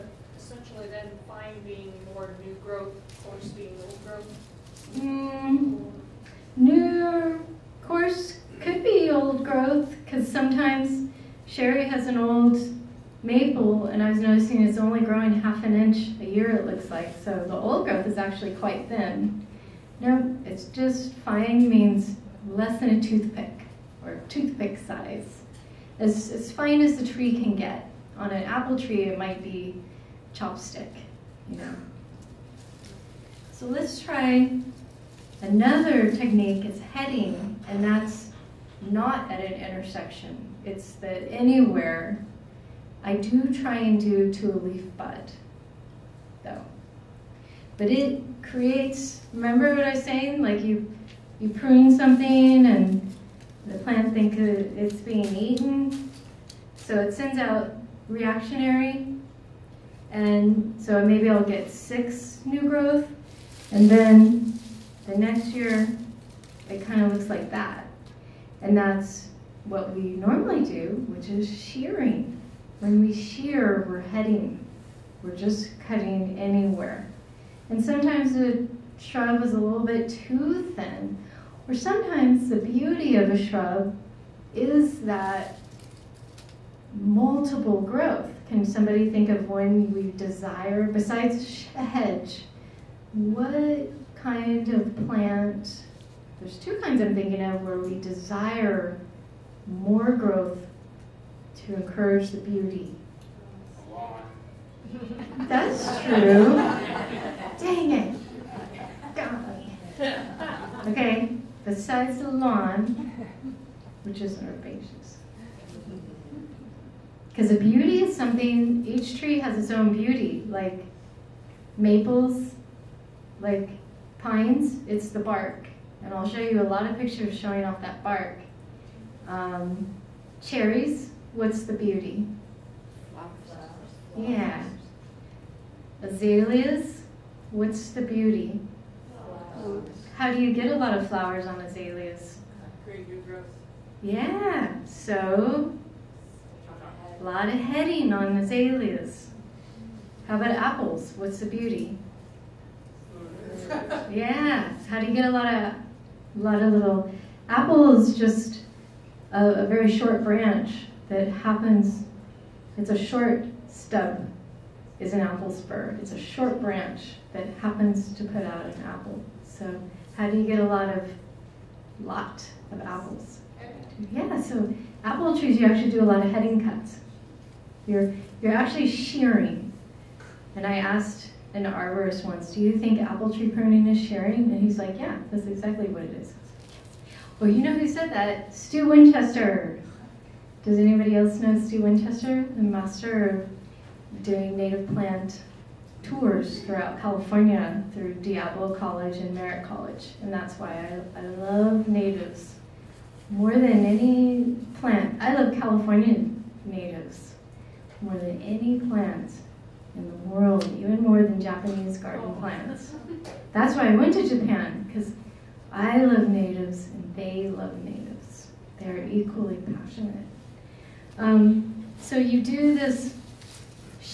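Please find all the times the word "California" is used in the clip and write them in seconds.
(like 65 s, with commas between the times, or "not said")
197 s, 205 s.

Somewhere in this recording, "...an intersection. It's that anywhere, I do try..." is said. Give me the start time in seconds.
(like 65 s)
39 s.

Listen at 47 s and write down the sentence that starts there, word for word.
But it creates, remember what I was saying?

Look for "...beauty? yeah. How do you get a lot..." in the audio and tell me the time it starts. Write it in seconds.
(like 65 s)
151 s.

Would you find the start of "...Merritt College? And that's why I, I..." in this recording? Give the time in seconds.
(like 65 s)
199 s.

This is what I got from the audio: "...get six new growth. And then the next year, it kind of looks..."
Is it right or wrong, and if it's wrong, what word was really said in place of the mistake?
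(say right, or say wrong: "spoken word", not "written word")
right.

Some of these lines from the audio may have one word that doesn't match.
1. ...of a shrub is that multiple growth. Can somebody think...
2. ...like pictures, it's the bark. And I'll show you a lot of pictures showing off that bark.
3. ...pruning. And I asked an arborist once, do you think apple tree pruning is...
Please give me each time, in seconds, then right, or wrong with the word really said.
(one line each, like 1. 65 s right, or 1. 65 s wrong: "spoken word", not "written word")
1. 83 s right
2. 123 s wrong: "pines", not "pictures"
3. 178 s wrong: "shearing", not "pruning".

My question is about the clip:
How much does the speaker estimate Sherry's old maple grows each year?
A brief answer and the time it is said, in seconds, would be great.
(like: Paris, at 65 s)
half an inch, at 15 s.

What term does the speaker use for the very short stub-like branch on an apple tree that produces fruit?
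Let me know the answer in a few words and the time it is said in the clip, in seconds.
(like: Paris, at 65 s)
apple spur, at 165 s.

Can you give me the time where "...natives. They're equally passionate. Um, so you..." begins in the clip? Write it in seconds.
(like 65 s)
217 s.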